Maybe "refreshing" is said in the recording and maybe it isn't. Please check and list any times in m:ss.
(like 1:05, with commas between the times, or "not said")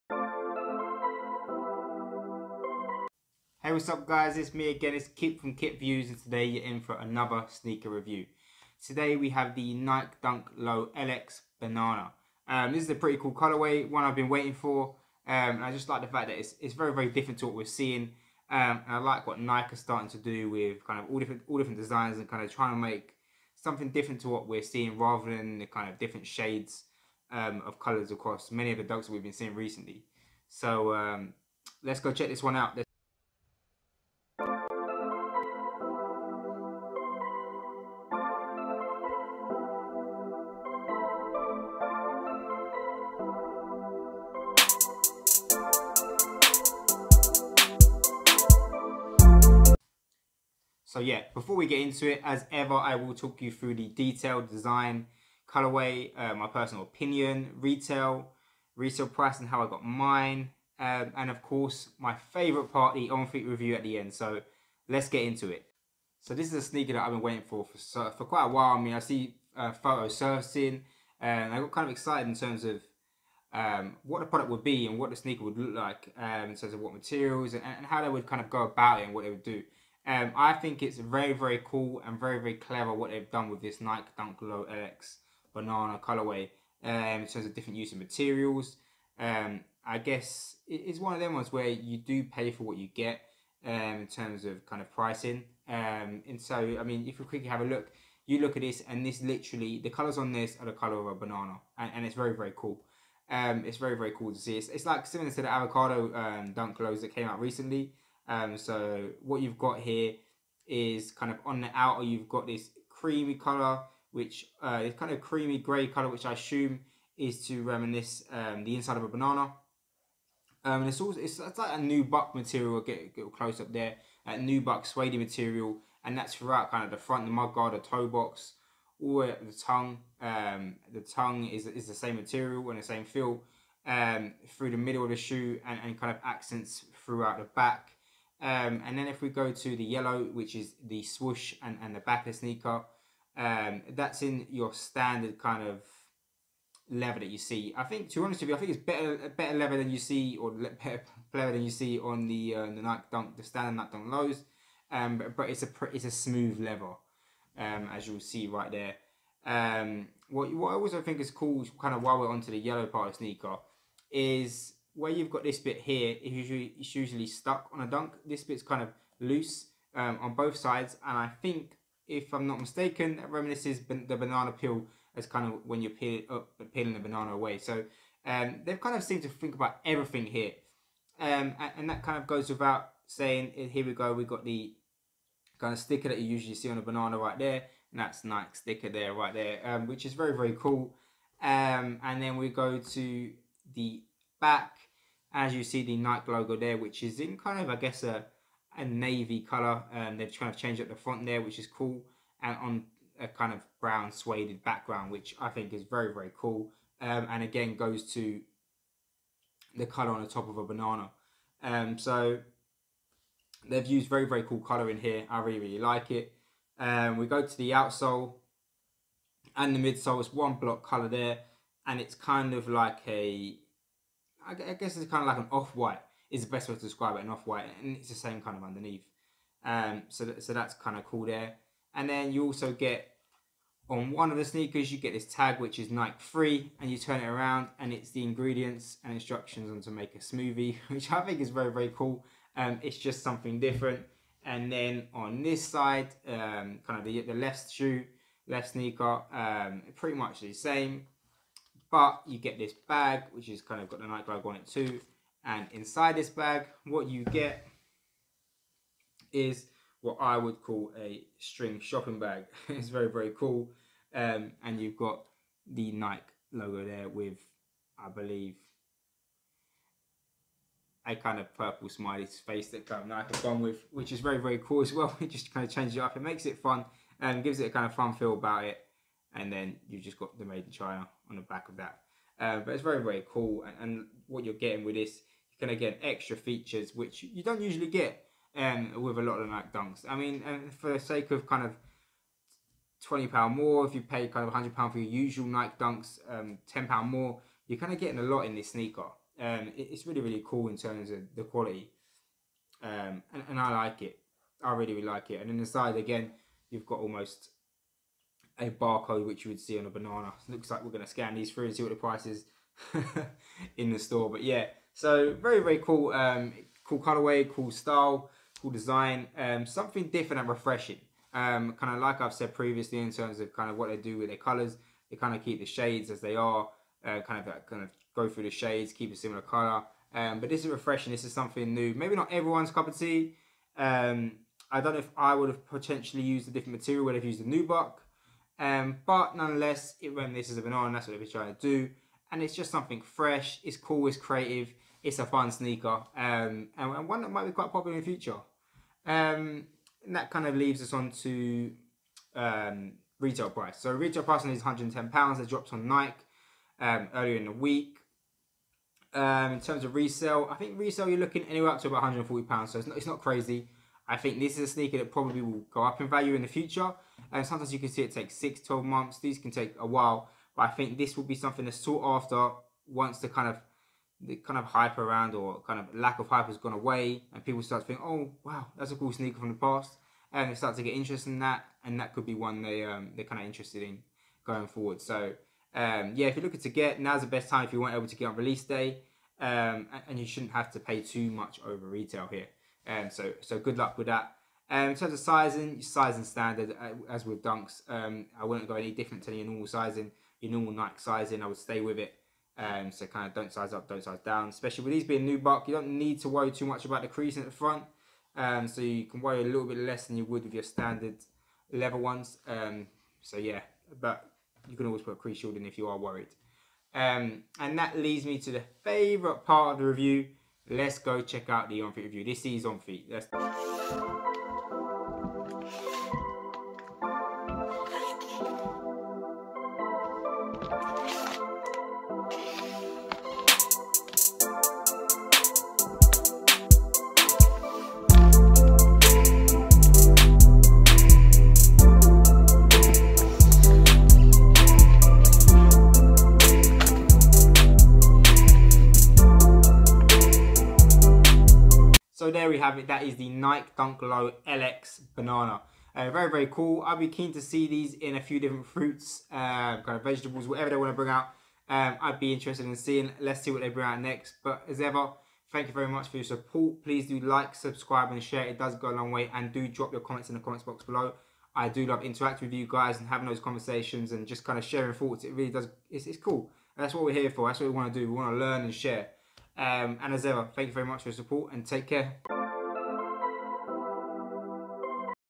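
5:20, 5:30.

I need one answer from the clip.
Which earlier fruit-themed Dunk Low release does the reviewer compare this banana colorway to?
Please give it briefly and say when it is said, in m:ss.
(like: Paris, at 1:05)
Avocado, at 1:45.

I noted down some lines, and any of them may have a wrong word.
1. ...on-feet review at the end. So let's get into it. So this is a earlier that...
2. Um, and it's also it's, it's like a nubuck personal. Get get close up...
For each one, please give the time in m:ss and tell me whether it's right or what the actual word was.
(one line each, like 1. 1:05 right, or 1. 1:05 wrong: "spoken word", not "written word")
1. 1:03 wrong: "sneaker", not "earlier"
2. 2:00 wrong: "material", not "personal".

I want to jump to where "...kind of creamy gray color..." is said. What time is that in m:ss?
1:54.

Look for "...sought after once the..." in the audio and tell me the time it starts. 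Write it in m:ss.
6:11.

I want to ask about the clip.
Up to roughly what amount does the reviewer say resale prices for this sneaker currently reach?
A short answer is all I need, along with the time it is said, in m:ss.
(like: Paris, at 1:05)
£140, at 6:02.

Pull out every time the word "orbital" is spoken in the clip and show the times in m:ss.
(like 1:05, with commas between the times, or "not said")
not said.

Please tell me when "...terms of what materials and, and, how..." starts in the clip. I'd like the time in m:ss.
1:16.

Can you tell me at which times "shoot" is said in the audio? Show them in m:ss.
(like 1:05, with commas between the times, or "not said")
not said.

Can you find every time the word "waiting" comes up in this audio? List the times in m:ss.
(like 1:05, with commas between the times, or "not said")
0:14, 1:07.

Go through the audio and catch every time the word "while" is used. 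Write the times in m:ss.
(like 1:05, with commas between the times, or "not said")
1:08, 2:42, 6:09.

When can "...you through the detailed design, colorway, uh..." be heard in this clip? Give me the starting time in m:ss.
0:53.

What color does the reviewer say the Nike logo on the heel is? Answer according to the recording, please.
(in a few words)
Navy.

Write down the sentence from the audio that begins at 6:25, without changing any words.
So um, yeah, if you're looking to get, now's the best time if you weren't able to get on release day.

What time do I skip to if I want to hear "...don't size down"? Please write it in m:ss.
6:43.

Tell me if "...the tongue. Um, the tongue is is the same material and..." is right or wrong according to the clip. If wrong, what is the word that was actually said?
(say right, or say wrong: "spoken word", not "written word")
right.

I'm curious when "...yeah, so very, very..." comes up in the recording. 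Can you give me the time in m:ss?
5:14.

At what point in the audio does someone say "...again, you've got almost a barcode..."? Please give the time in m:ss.
5:05.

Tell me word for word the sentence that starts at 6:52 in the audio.
Um, so yeah, but you can always put a crease shield in if you are worried.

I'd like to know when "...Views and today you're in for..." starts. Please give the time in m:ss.
0:05.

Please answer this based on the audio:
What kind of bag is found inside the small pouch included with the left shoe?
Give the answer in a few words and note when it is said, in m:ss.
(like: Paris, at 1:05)
String shopping bag, at 4:21.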